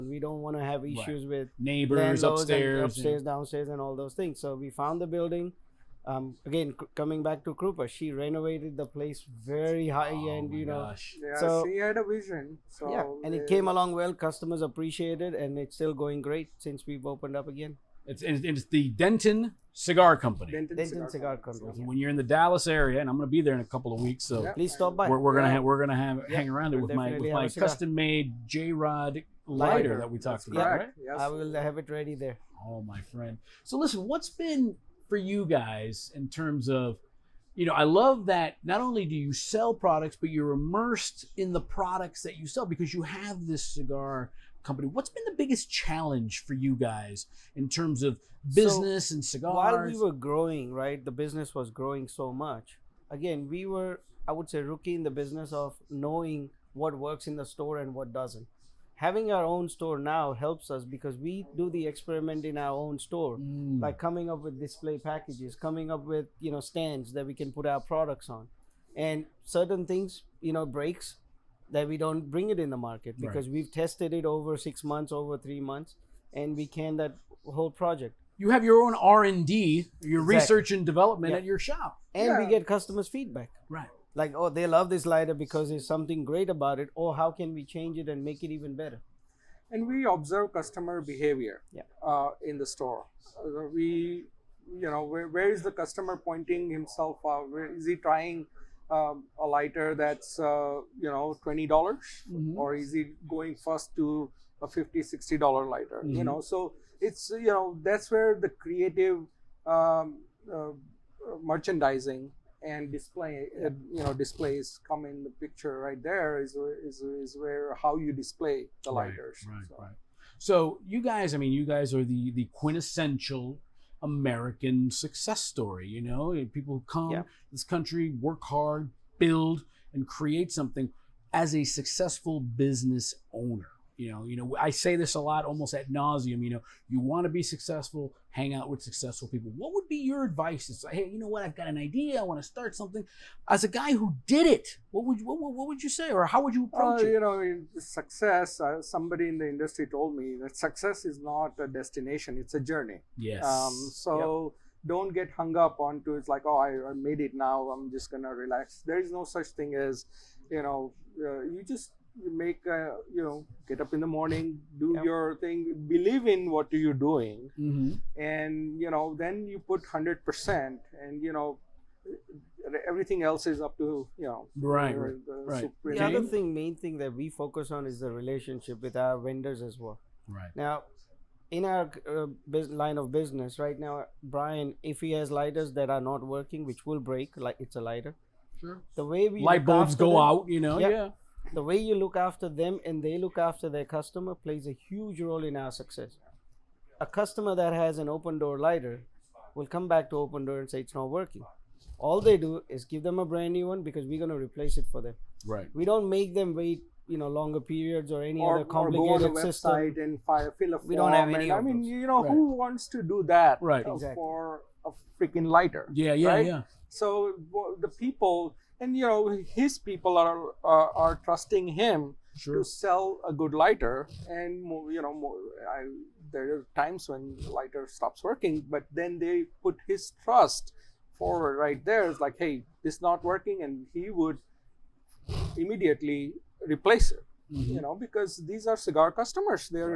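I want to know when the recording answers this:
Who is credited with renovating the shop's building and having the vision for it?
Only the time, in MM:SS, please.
00:07.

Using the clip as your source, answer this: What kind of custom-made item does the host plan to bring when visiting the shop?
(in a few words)
J Rod lighter.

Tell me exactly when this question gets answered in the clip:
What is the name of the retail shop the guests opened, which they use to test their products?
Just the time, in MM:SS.
00:18.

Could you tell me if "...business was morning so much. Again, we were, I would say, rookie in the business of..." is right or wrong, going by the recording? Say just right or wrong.
wrong.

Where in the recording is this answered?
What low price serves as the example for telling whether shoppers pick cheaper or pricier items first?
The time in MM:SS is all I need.
01:41.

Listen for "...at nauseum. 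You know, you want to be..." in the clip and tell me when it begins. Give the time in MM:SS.
02:15.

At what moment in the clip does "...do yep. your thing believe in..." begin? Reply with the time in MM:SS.
02:44.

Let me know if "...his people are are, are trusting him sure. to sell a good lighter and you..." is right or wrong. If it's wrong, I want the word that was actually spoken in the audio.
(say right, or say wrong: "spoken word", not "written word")
right.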